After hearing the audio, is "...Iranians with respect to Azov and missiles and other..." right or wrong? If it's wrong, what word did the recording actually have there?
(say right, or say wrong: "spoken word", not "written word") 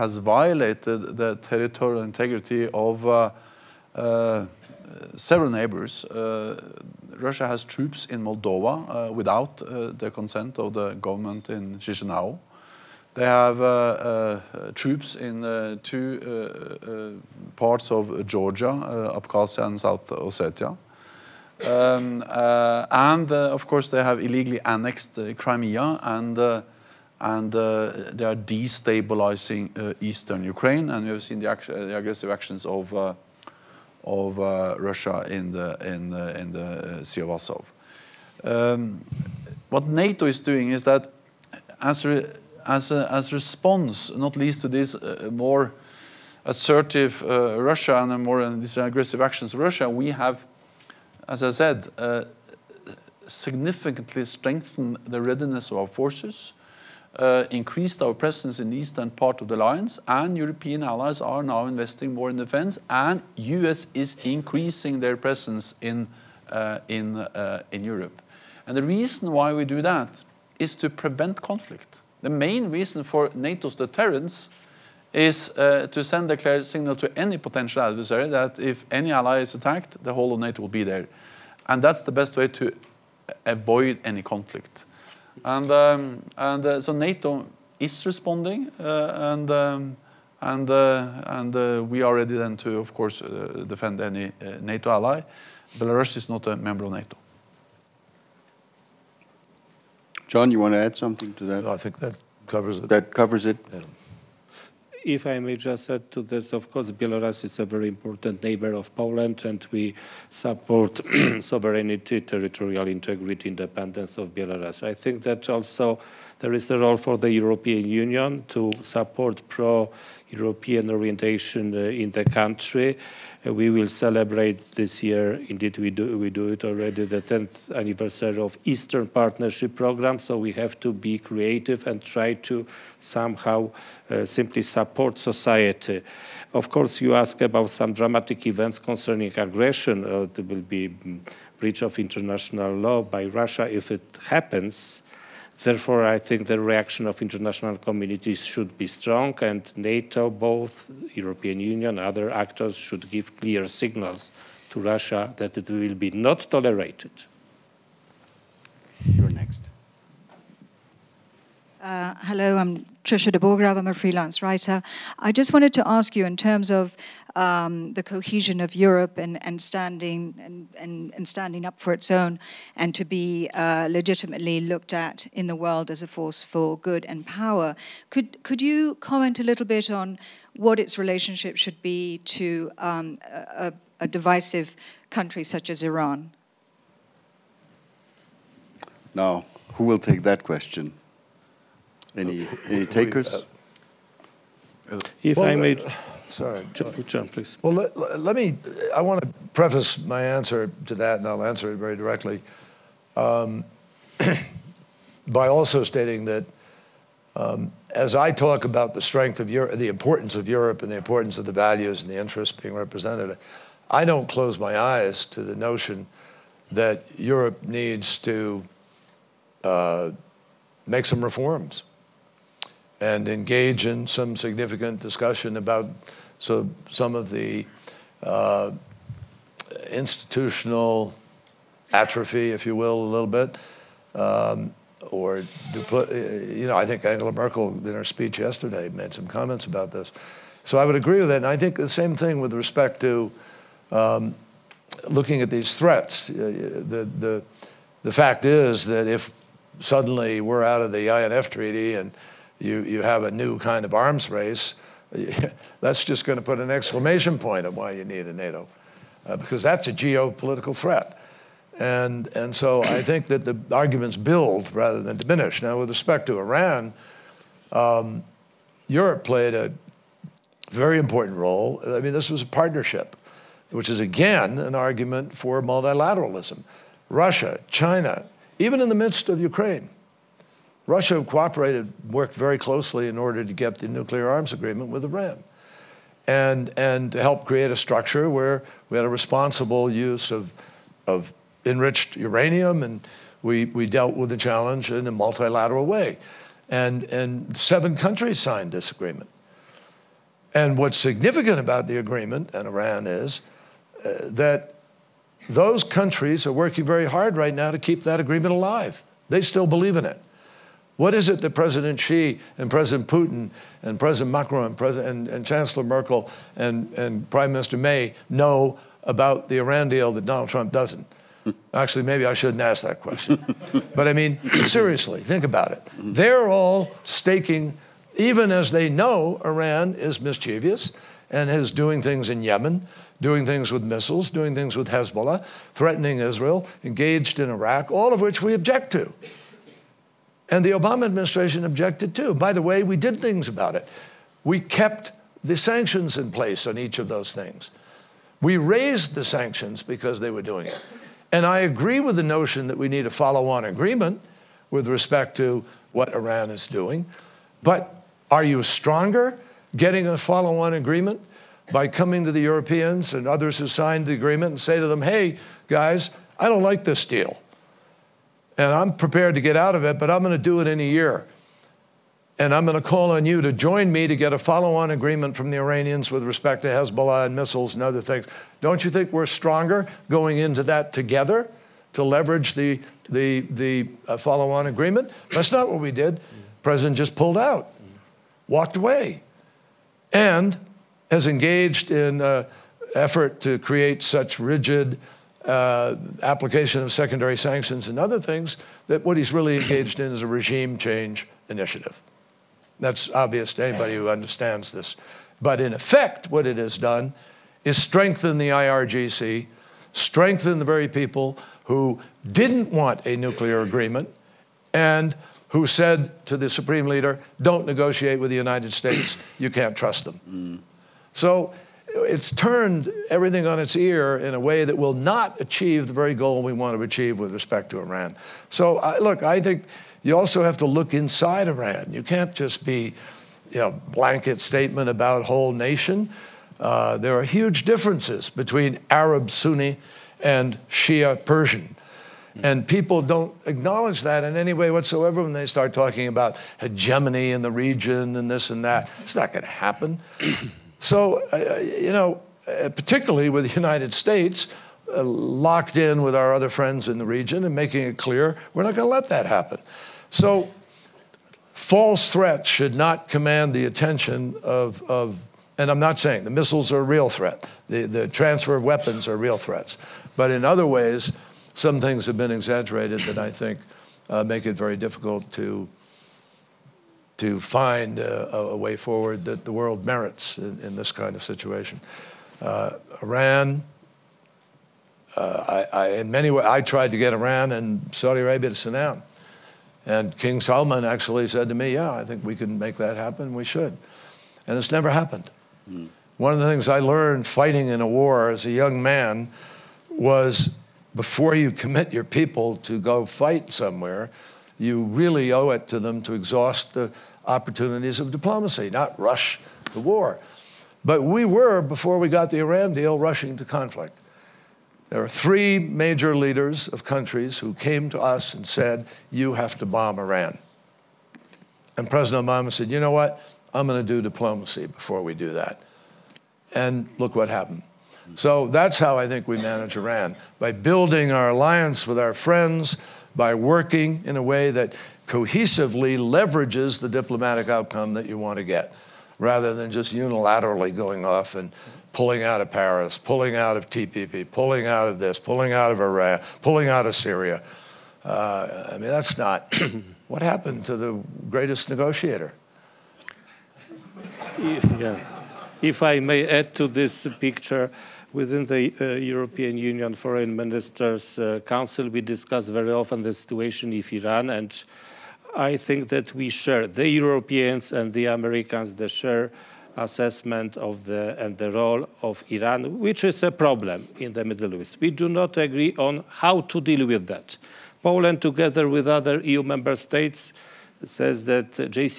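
wrong: "Hezbollah", not "Azov".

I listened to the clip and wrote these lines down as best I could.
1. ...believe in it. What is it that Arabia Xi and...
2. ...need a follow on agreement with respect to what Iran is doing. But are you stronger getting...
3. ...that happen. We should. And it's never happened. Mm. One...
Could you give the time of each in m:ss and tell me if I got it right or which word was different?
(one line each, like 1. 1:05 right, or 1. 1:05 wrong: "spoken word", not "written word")
1. 5:09 wrong: "President", not "Arabia"
2. 5:52 right
3. 8:12 right.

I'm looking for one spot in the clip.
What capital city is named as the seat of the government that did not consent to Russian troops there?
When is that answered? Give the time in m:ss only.
0:11.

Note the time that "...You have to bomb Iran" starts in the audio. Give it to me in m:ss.
8:39.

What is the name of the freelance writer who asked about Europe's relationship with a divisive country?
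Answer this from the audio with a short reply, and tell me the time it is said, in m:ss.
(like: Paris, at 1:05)
Trisha de Borgrave, at 2:43.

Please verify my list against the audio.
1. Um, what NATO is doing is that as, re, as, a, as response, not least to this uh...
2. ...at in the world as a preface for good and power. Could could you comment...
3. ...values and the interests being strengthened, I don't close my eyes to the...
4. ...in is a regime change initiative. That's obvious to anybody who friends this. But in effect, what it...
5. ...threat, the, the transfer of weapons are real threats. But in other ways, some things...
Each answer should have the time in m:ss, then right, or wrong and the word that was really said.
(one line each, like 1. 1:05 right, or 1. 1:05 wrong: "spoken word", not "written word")
1. 0:38 right
2. 2:54 wrong: "force", not "preface"
3. 3:31 wrong: "represented", not "strengthened"
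4. 6:39 wrong: "understands", not "friends"
5. 7:47 right.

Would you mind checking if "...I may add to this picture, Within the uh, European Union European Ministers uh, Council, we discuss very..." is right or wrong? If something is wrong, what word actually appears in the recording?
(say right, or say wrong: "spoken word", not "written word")
wrong: "Foreign", not "European".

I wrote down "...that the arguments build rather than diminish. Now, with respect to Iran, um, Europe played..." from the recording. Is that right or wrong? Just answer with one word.
right.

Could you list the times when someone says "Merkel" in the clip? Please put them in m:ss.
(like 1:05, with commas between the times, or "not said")
3:57, 5:15.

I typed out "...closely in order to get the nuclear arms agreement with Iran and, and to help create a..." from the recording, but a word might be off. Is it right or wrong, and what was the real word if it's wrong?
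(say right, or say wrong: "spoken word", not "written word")
right.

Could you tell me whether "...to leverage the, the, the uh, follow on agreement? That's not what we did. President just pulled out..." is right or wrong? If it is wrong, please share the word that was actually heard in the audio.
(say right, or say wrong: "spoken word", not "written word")
right.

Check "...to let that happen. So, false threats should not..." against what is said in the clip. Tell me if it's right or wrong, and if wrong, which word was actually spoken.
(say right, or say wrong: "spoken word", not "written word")
right.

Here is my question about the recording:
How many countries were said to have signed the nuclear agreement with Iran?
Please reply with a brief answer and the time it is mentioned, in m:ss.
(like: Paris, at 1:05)
7, at 4:57.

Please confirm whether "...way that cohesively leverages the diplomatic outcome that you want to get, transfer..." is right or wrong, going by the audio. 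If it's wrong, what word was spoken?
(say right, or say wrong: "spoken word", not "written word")
wrong: "rather", not "transfer".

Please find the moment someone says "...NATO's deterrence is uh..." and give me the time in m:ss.
1:13.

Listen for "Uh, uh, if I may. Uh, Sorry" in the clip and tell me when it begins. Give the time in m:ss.
3:13.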